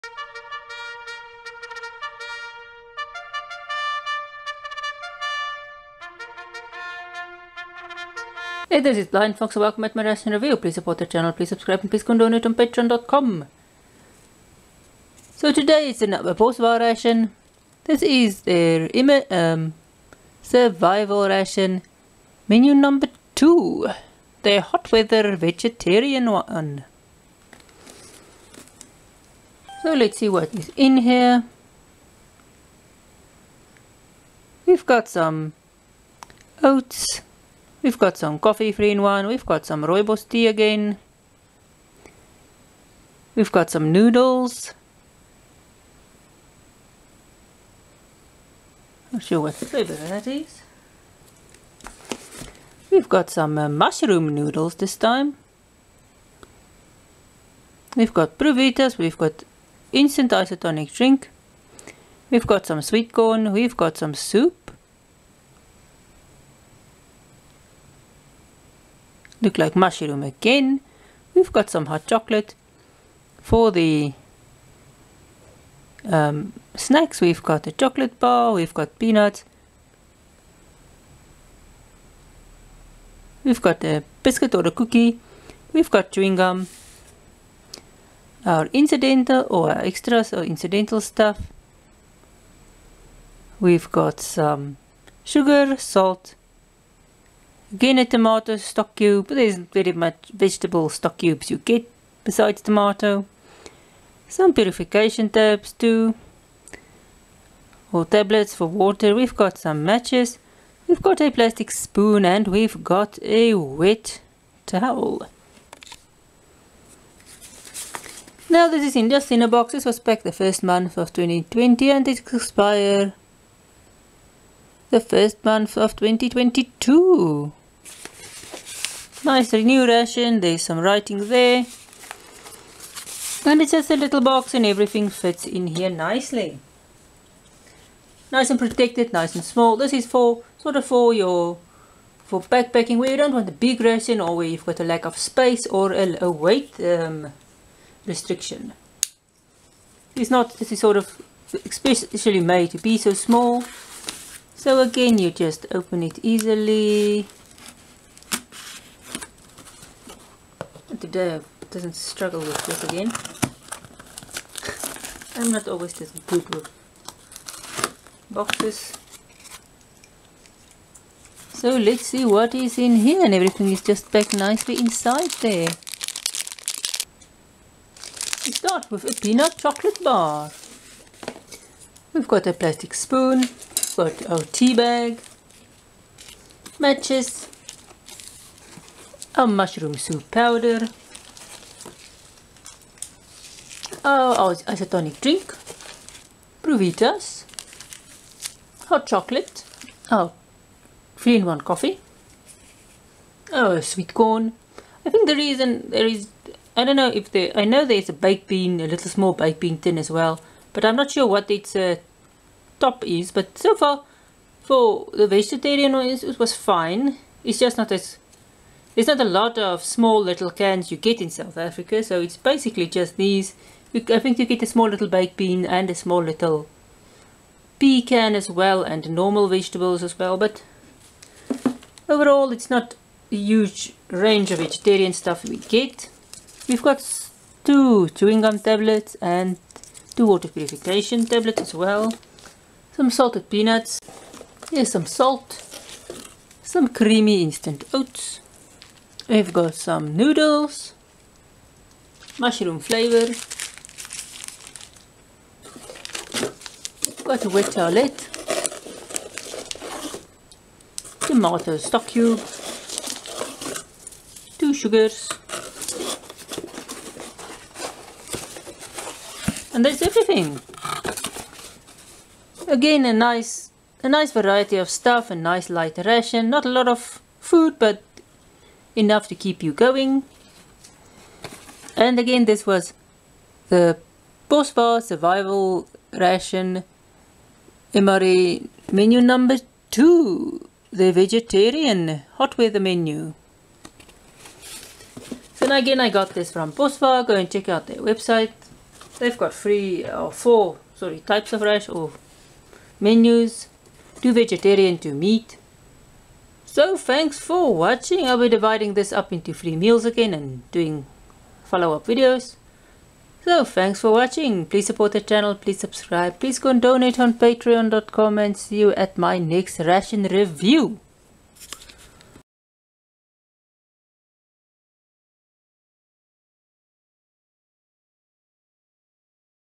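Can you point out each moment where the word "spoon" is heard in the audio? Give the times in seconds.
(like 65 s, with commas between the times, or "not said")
111 s, 182 s.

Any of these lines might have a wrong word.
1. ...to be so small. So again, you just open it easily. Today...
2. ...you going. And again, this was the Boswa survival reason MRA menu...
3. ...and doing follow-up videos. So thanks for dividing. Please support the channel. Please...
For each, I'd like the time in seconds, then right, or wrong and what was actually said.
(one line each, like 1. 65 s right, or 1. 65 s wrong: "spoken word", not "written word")
1. 152 s right
2. 279 s wrong: "ration", not "reason"
3. 310 s wrong: "watching", not "dividing".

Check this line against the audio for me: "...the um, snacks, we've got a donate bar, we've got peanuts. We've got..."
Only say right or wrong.
wrong.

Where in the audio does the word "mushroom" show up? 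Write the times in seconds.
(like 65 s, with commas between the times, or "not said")
53 s, 69 s, 189 s, 252 s.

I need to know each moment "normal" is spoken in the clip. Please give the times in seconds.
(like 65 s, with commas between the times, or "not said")
229 s.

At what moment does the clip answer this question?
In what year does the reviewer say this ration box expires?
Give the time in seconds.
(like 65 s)
125 s.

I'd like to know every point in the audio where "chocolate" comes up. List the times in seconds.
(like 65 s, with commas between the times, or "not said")
72 s, 77 s, 179 s, 199 s.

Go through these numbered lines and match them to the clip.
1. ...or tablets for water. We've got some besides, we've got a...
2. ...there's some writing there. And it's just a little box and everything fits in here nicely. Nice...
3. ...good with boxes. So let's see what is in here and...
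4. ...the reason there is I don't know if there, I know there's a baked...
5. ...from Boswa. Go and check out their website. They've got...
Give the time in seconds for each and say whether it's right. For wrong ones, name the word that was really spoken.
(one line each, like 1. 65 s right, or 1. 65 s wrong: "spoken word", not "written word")
1. 107 s wrong: "matches", not "besides"
2. 130 s right
3. 166 s right
4. 205 s right
5. 296 s right.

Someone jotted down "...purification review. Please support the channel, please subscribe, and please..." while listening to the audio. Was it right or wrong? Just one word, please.
wrong.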